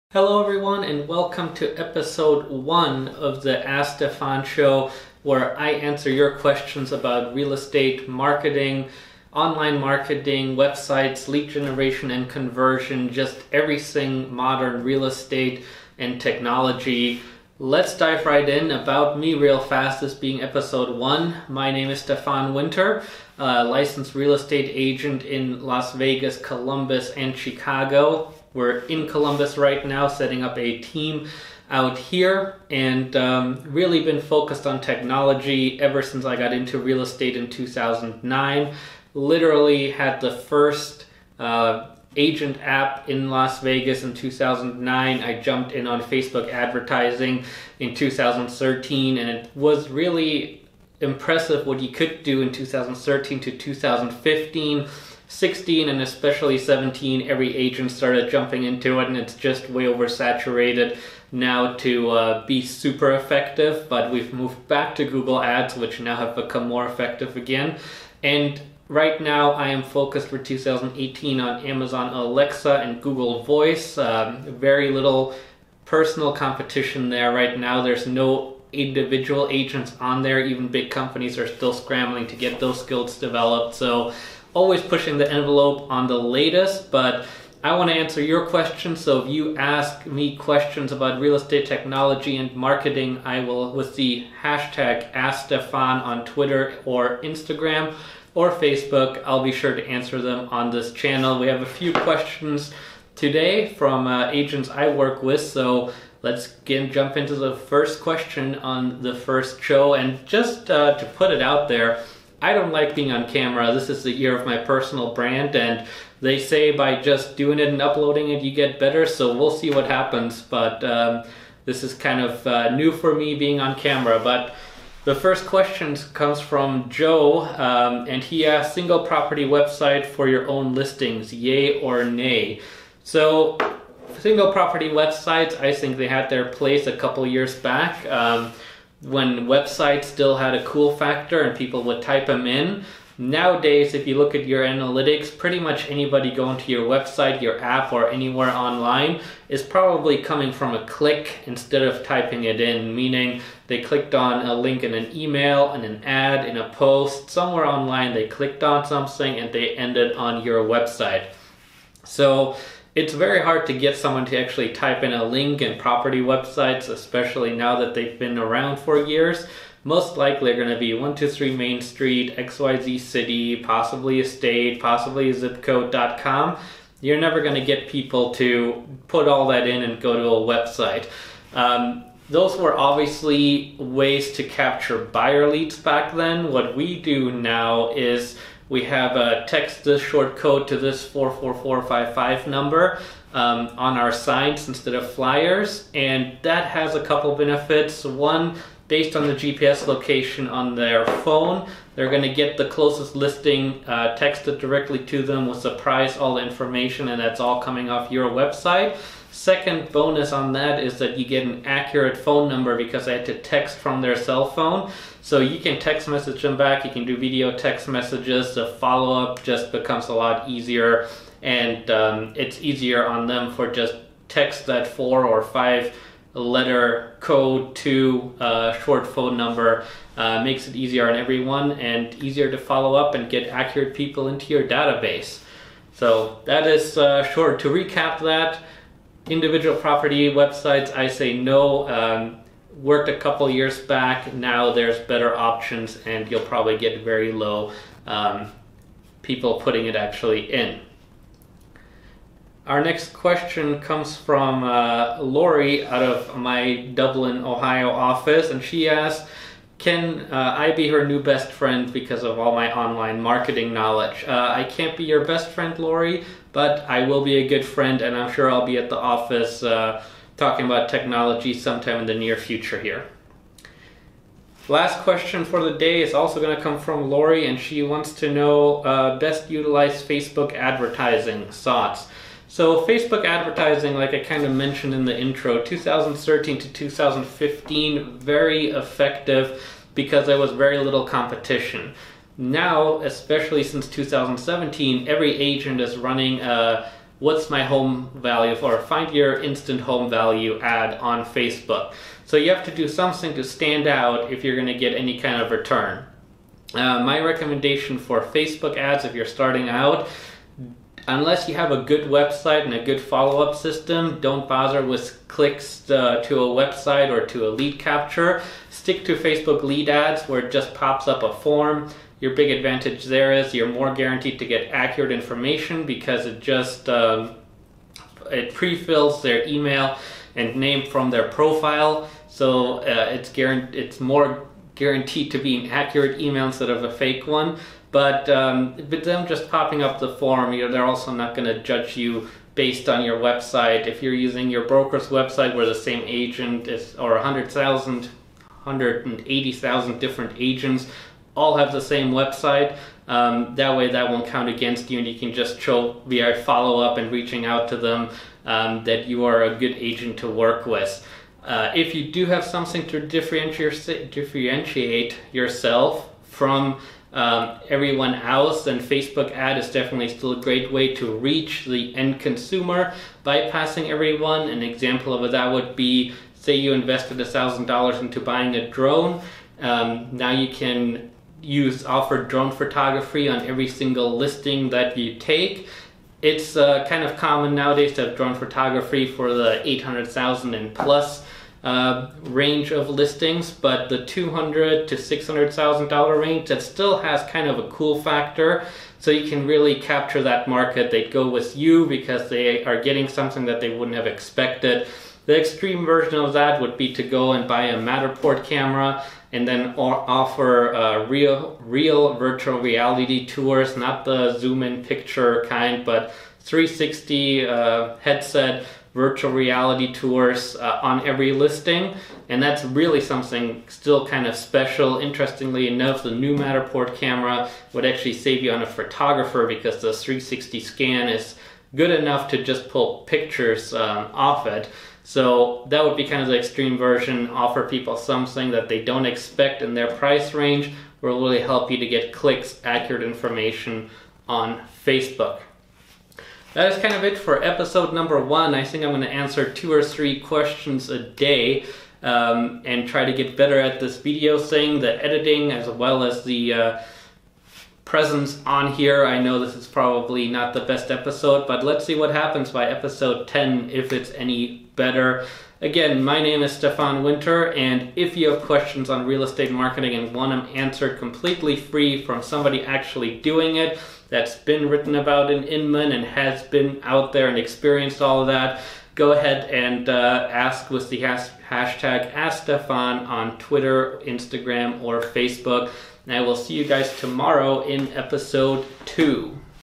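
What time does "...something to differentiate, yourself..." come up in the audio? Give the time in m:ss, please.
6:02.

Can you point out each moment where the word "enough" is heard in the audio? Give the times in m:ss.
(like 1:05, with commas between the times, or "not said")
7:05, 7:11.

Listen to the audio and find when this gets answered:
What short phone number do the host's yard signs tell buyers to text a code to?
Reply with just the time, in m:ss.
3:11.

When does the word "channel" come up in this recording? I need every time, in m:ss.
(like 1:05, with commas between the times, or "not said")
1:40.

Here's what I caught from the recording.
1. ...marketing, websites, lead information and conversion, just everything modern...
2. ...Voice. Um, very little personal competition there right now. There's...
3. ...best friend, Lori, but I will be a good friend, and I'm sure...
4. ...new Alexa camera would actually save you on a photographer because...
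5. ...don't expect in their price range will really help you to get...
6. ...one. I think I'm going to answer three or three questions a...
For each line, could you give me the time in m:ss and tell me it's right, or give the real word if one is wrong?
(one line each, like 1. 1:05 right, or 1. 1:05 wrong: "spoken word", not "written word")
1. 0:09 wrong: "generation", not "information"
2. 1:13 right
3. 4:25 right
4. 7:06 wrong: "Matterport", not "Alexa"
5. 7:18 right
6. 7:28 wrong: "two", not "three".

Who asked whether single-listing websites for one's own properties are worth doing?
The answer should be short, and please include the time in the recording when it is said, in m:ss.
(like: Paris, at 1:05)
Joe, at 2:06.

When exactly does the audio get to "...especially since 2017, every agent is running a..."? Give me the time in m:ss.
4:53.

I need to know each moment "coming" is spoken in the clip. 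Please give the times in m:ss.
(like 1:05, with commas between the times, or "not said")
2:30, 3:27.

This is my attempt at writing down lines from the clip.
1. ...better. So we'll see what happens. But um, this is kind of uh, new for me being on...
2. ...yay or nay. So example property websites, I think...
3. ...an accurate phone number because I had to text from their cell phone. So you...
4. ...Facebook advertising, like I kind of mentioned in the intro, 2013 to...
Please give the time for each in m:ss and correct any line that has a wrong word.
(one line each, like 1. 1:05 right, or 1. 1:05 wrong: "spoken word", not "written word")
1. 1:58 right
2. 2:11 wrong: "single", not "example"
3. 3:31 right
4. 4:42 right.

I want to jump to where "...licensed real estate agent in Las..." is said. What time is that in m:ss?
0:23.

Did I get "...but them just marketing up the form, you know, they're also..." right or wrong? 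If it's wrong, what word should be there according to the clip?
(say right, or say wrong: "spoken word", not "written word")
wrong: "popping", not "marketing".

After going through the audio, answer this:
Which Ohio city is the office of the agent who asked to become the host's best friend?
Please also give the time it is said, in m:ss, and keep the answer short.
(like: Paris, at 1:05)
Dublin, at 4:16.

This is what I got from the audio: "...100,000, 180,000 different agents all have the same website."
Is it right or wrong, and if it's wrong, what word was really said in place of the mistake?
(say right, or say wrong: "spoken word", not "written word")
right.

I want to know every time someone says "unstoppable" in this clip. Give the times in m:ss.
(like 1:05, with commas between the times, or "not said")
not said.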